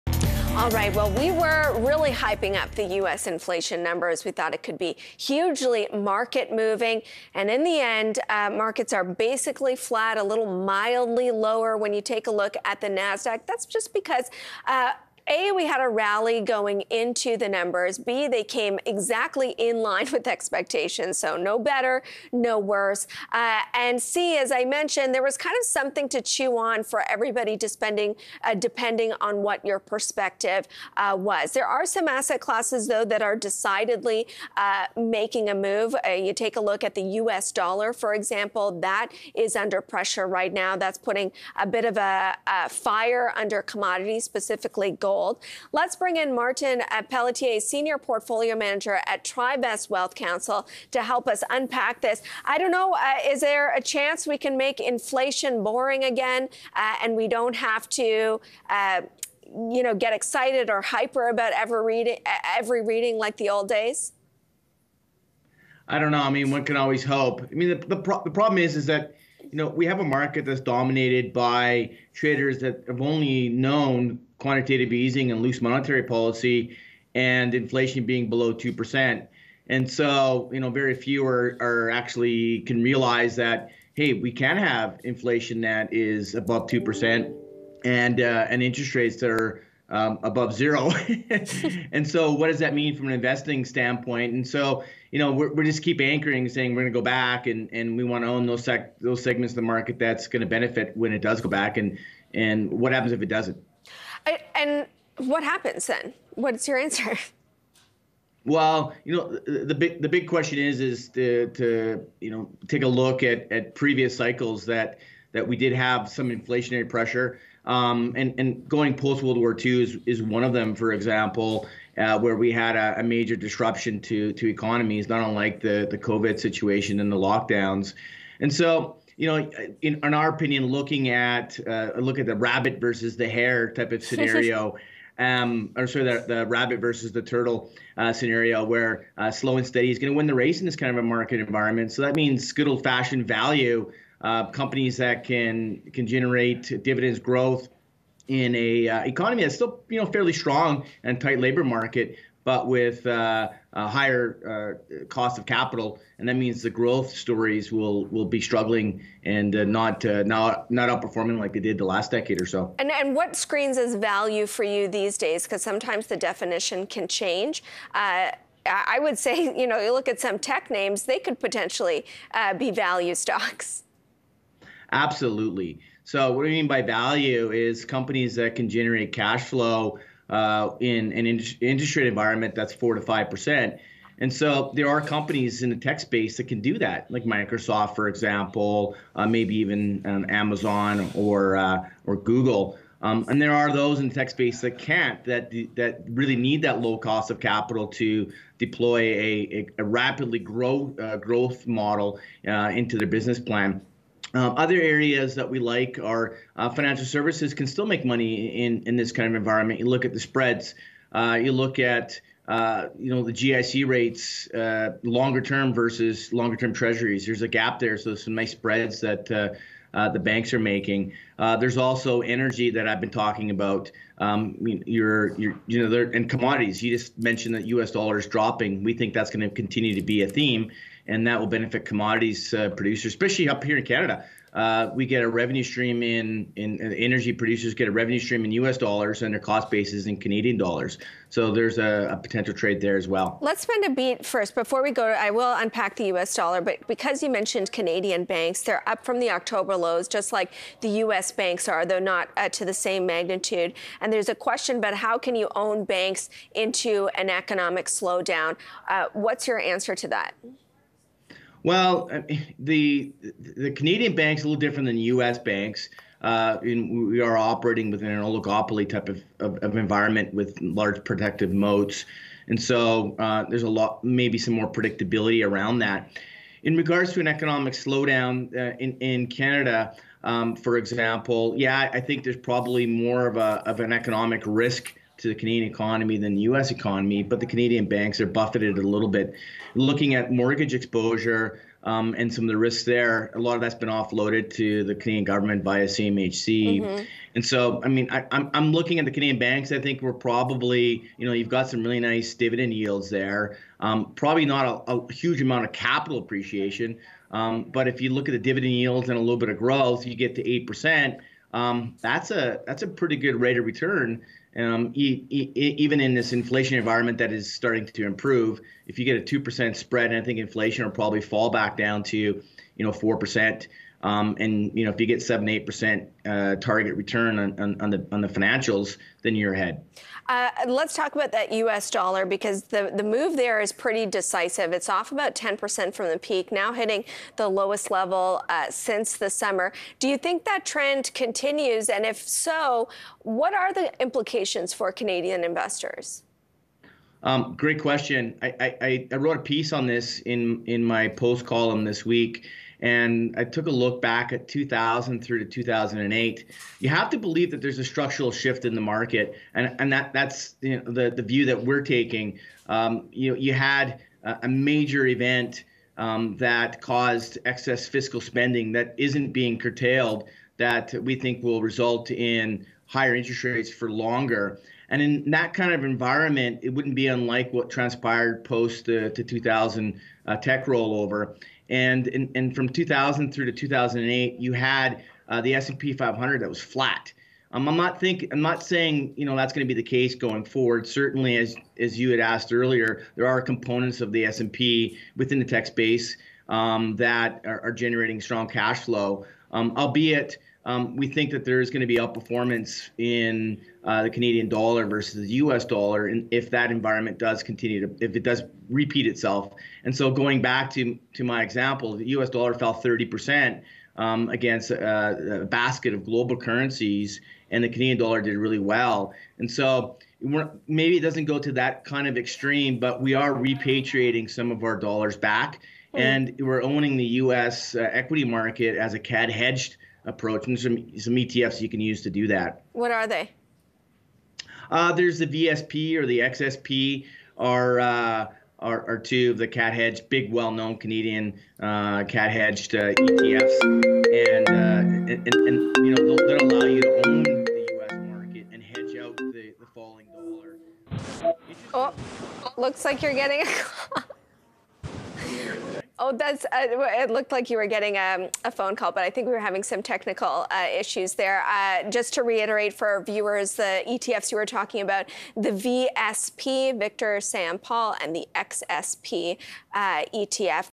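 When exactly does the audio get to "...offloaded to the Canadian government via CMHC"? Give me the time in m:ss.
4:53.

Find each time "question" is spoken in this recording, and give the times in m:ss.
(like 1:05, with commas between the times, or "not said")
1:50, 4:14, 5:47.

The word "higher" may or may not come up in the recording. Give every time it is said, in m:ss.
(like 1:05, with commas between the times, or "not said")
2:33, 6:12.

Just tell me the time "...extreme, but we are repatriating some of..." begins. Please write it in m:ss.
7:02.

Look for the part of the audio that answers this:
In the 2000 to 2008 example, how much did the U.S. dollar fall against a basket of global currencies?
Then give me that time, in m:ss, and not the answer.
6:52.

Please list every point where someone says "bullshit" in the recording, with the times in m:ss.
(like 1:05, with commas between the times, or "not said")
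not said.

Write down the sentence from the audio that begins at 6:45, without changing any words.
dollar, and if that environment does continue to, if it does repeat itself.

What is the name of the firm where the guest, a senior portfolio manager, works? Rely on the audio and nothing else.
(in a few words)
TriVest Wealth Counsel.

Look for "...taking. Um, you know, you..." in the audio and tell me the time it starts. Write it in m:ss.
6:01.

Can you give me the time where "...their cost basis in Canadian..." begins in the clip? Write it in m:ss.
3:59.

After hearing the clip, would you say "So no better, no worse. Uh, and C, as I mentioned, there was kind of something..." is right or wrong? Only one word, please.
right.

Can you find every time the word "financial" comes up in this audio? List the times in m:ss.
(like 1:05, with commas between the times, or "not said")
3:26, 5:28.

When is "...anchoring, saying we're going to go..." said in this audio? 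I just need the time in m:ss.
1:35.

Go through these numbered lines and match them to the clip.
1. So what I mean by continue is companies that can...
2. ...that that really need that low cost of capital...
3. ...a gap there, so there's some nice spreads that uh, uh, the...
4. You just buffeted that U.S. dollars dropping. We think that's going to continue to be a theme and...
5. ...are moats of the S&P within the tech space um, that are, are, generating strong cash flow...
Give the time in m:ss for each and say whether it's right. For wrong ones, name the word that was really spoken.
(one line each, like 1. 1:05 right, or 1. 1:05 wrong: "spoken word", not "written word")
1. 2:56 wrong: "value", not "continue"
2. 3:15 right
3. 3:37 right
4. 3:46 wrong: "mentioned", not "buffeted"
5. 6:33 wrong: "components", not "moats".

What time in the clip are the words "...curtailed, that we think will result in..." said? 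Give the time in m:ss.
6:09.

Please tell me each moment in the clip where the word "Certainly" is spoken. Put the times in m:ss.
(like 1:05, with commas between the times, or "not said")
6:30.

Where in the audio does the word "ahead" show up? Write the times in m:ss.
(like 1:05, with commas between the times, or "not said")
5:29.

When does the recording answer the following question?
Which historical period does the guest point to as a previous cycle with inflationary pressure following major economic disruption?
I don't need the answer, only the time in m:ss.
1:58.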